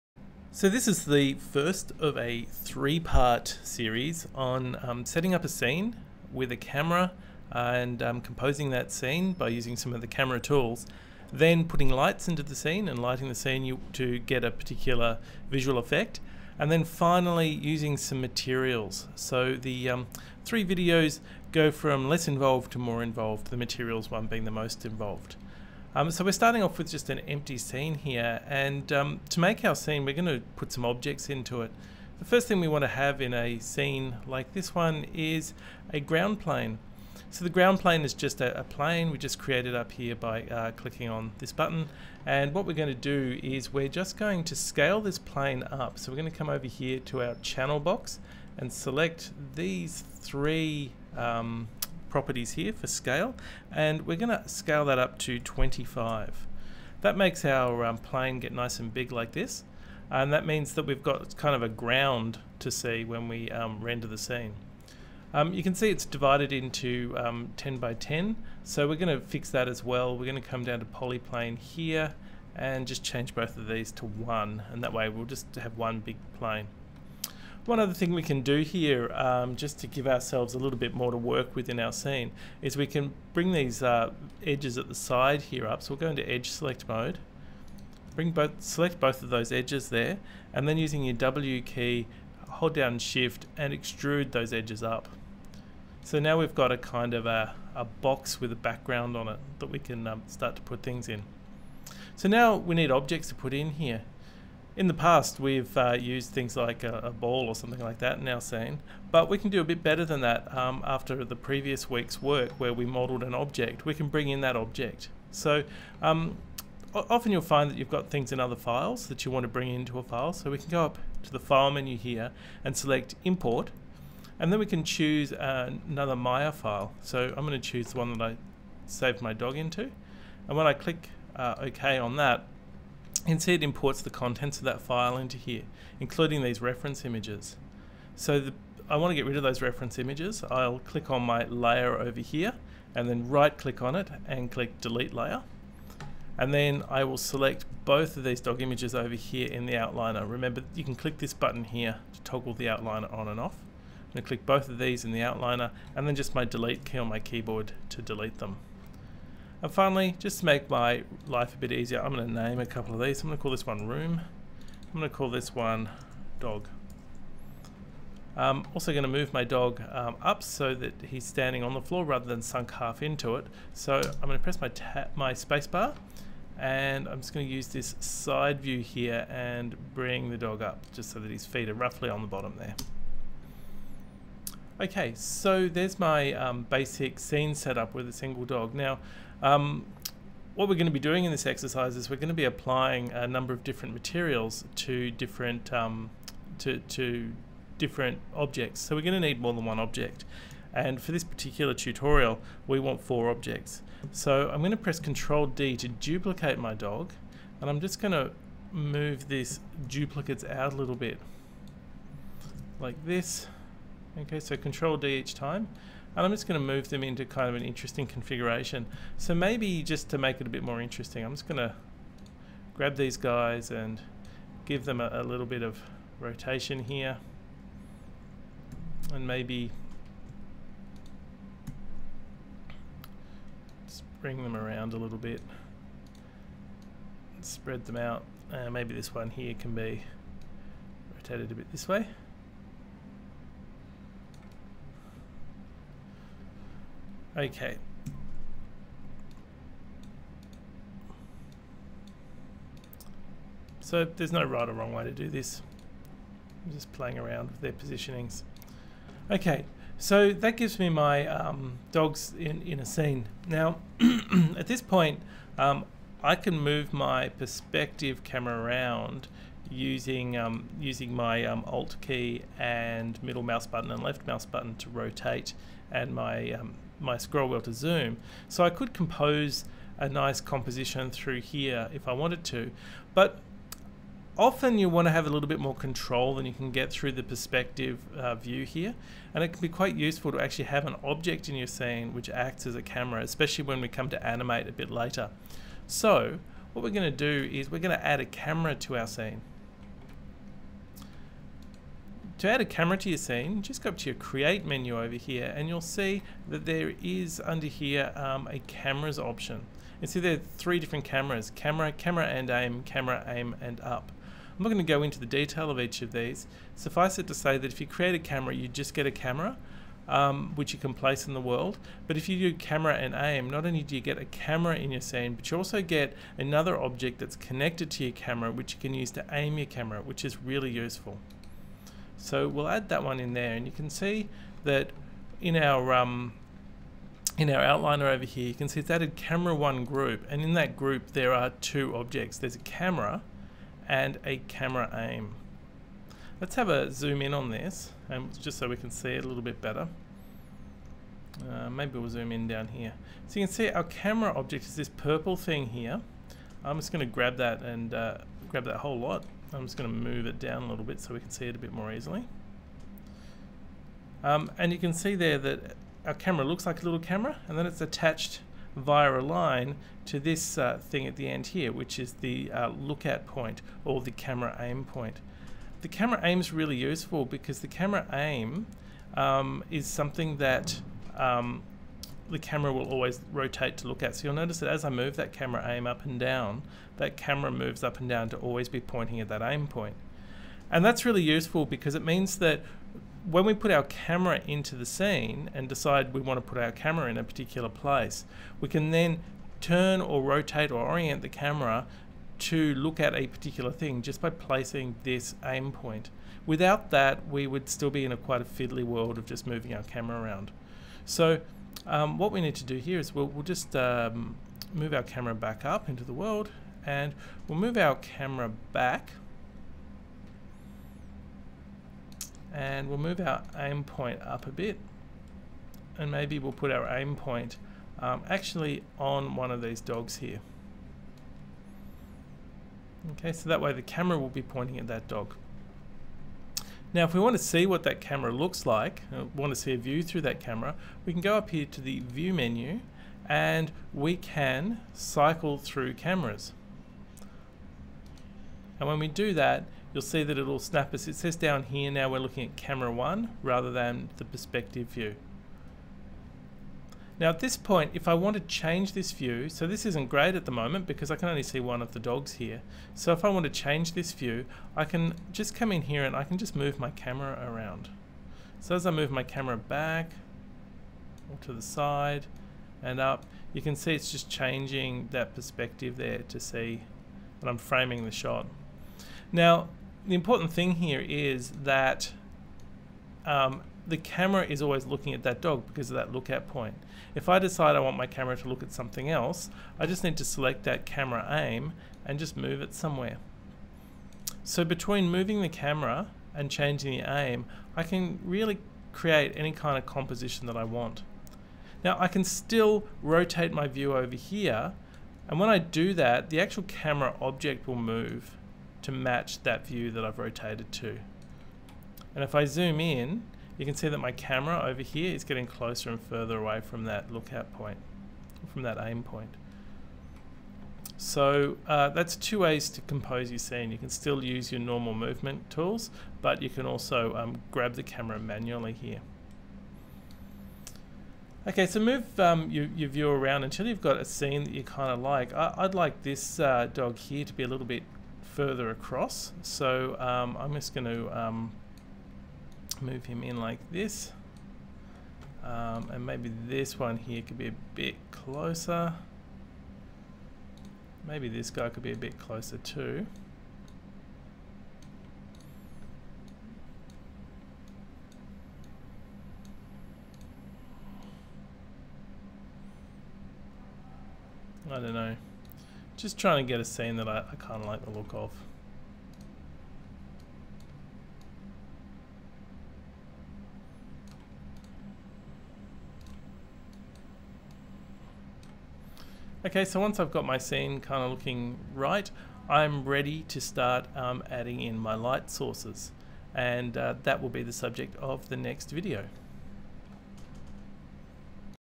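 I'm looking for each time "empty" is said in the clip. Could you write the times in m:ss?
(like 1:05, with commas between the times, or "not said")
0:27.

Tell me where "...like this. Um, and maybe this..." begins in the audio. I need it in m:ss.
9:03.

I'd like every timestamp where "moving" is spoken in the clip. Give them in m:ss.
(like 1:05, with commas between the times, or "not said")
6:49, 8:15.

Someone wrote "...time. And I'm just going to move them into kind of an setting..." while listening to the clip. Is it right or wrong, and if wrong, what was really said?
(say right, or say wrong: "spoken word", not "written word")
wrong: "interesting", not "setting".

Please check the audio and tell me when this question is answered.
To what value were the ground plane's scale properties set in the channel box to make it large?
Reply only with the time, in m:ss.
0:55.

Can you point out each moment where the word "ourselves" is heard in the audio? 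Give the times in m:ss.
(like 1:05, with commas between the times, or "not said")
1:20.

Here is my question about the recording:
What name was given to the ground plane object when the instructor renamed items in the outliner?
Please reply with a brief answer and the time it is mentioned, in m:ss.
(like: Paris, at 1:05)
room, at 2:43.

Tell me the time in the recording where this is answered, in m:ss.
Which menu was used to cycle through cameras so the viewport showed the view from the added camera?
7:21.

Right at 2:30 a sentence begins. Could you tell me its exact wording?
Remember, you can click this button here to toggle the outliner on and off.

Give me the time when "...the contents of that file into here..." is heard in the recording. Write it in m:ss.
2:14.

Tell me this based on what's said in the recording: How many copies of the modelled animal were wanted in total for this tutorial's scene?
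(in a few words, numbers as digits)
4.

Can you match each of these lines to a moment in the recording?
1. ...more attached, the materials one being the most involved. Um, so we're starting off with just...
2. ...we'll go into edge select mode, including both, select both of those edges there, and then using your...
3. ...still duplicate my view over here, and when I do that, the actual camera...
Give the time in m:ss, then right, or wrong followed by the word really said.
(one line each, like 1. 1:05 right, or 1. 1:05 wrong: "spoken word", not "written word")
1. 0:22 wrong: "involved", not "attached"
2. 1:25 wrong: "bring", not "including"
3. 8:22 wrong: "rotate", not "duplicate".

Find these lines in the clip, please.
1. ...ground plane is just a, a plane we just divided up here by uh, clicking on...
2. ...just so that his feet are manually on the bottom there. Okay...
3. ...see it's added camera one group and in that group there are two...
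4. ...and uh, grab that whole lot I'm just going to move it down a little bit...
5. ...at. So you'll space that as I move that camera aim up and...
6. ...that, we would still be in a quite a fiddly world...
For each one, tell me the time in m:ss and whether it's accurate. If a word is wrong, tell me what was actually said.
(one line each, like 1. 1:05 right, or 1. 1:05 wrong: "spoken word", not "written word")
1. 0:37 wrong: "created", not "divided"
2. 3:00 wrong: "roughly", not "manually"
3. 5:38 right
4. 5:57 right
5. 6:24 wrong: "notice", not "space"
6. 6:46 right.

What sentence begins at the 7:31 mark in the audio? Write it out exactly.
It says down here now we're looking at camera one rather than the perspective view.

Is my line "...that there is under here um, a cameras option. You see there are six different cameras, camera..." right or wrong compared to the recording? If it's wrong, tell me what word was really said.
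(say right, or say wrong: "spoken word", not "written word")
wrong: "three", not "six".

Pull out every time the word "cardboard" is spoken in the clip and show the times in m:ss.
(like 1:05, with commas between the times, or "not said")
not said.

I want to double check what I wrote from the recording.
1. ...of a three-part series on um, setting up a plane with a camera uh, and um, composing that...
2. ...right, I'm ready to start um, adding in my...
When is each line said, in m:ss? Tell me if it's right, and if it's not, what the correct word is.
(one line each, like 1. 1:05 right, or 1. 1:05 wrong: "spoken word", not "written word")
1. 0:02 wrong: "scene", not "plane"
2. 9:41 right.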